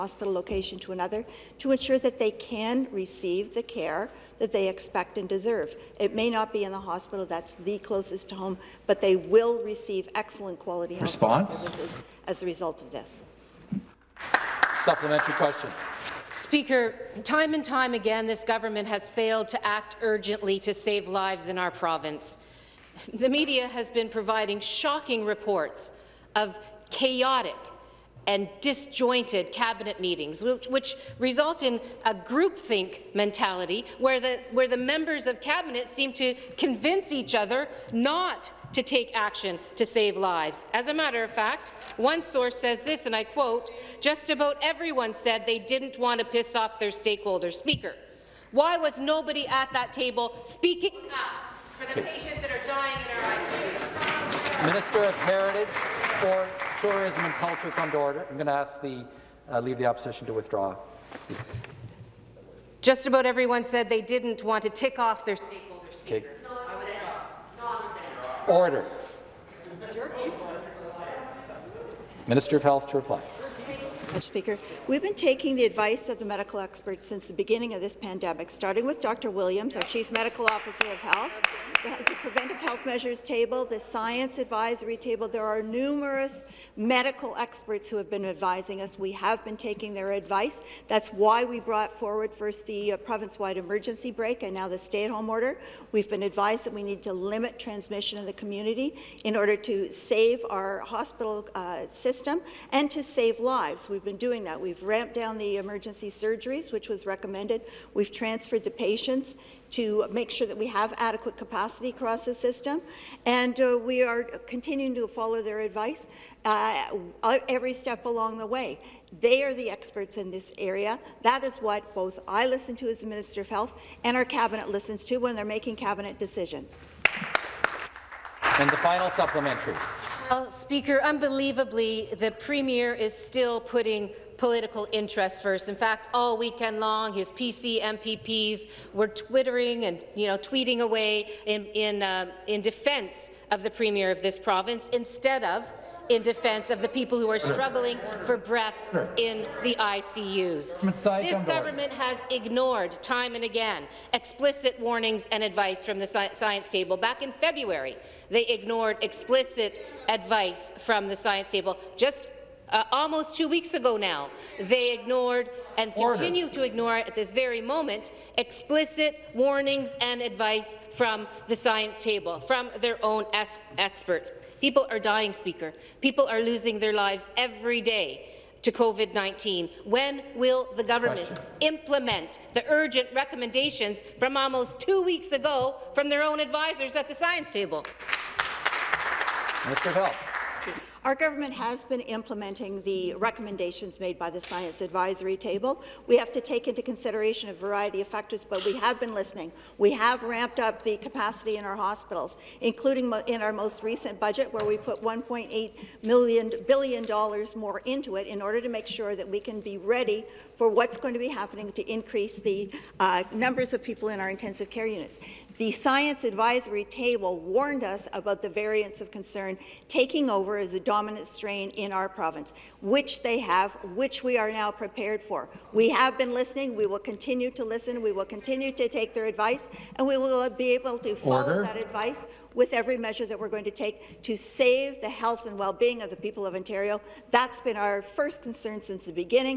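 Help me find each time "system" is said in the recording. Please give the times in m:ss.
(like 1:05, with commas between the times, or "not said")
1:41, 1:52.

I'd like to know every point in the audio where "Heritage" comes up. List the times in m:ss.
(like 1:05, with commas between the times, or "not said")
0:55.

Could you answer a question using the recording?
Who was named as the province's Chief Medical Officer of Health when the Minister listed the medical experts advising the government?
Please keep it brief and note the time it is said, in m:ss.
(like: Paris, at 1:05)
Dr. Williams, at 1:18.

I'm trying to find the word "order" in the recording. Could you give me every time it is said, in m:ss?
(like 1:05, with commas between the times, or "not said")
0:57, 1:08, 1:35, 1:39, 3:28, 3:51.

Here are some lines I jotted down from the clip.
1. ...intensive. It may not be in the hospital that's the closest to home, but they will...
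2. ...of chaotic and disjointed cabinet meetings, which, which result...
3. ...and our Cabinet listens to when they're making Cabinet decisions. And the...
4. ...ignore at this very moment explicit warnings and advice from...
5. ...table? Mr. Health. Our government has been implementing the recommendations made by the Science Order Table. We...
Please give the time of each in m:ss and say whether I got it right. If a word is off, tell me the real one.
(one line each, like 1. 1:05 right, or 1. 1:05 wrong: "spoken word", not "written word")
1. 0:05 wrong: "deserve", not "intensive"
2. 0:26 right
3. 2:04 right
4. 2:46 right
5. 3:07 wrong: "Advisory", not "Order".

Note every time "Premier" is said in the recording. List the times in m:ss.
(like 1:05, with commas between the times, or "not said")
2:12, 2:23.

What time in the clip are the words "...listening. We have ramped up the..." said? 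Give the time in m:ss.
3:19.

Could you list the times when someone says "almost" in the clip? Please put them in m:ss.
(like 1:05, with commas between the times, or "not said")
2:42, 3:04.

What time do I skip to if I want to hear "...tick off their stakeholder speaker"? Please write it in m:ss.
1:04.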